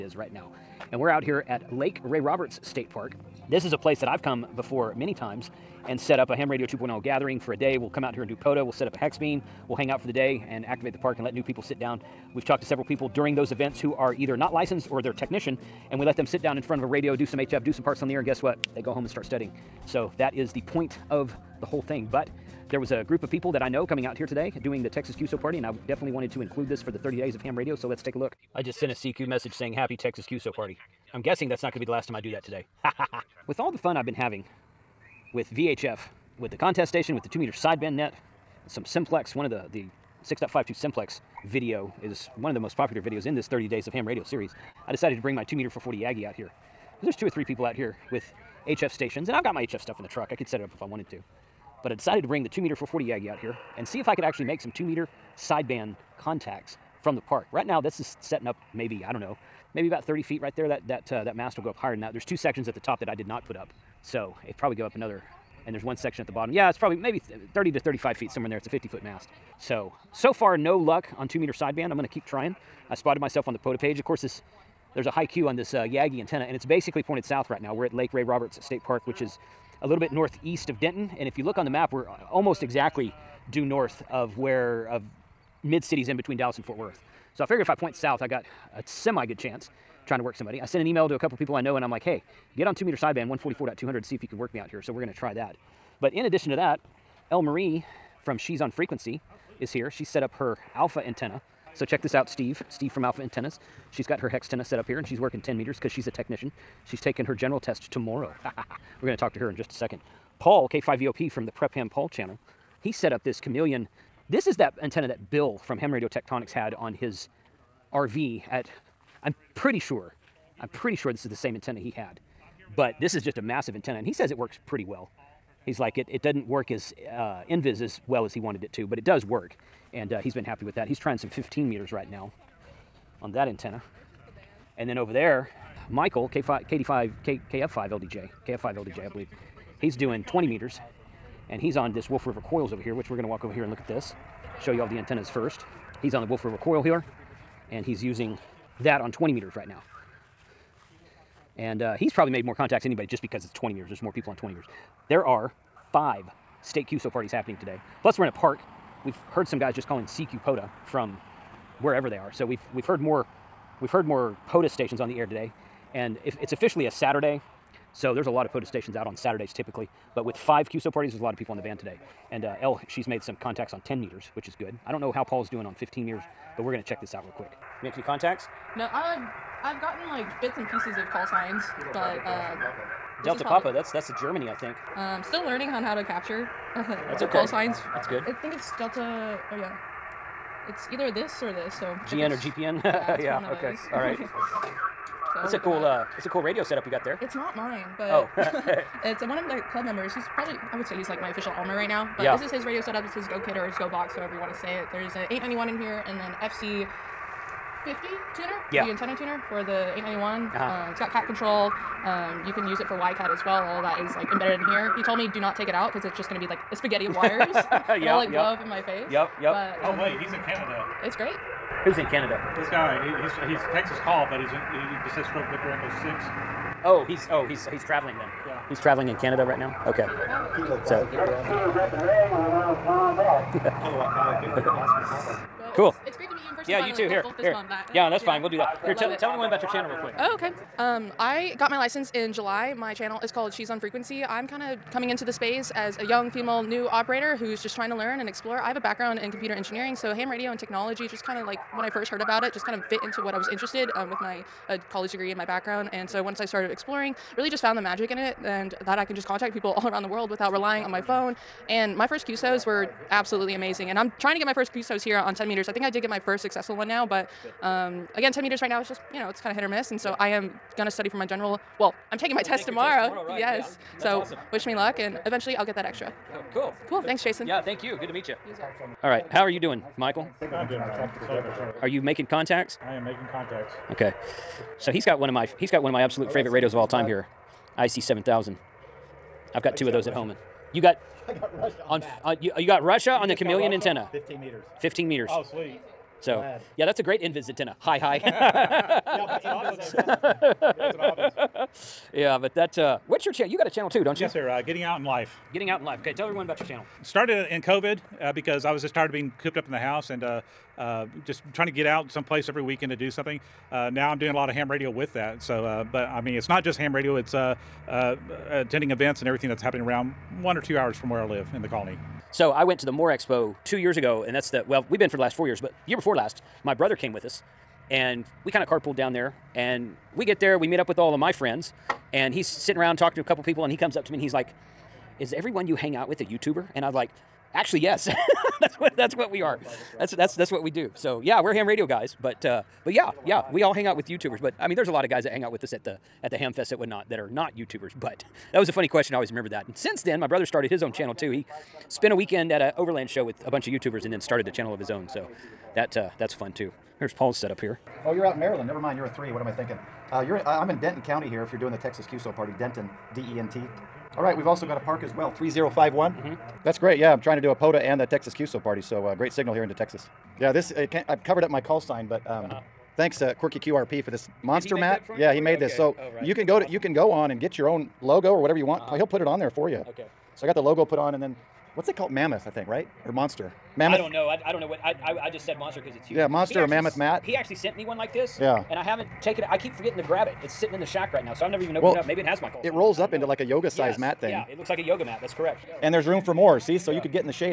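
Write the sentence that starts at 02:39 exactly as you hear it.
We've heard some guys just calling CQ POTA from wherever they are.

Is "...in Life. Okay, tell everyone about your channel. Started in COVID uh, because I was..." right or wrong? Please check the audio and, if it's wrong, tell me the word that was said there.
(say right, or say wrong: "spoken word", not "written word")
right.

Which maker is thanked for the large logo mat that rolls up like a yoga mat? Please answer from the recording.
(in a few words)
Quirky QRP.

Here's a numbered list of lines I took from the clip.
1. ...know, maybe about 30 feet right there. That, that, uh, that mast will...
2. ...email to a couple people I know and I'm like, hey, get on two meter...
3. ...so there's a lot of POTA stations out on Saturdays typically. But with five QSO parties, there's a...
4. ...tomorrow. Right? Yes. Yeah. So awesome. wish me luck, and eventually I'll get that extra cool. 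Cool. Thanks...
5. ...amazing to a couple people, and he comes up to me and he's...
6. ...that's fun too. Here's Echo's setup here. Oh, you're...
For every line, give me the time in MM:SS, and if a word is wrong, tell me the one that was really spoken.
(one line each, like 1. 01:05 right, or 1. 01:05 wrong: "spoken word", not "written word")
1. 00:59 right
2. 01:30 right
3. 02:47 right
4. 04:33 right
5. 05:32 wrong: "talking", not "amazing"
6. 05:56 wrong: "Paul", not "Echo".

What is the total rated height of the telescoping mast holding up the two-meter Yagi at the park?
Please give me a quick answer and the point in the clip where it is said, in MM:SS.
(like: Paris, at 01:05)
50 feet, at 01:08.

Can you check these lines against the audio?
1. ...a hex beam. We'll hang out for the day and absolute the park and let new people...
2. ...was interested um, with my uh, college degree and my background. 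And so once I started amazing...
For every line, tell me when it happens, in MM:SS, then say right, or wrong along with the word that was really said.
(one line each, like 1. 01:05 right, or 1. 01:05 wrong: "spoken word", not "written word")
1. 00:08 wrong: "activate", not "absolute"
2. 04:13 wrong: "exploring", not "amazing".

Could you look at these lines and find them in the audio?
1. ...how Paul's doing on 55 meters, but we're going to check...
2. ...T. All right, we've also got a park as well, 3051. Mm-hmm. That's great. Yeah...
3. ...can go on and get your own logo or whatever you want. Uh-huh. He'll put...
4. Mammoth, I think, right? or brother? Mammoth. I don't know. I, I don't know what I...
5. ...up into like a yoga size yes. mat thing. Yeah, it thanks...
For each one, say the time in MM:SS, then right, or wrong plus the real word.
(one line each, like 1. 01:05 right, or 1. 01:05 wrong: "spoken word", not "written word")
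1. 02:55 wrong: "15", not "55"
2. 06:03 right
3. 06:16 right
4. 06:22 wrong: "monster", not "brother"
5. 06:32 wrong: "looks", not "thanks".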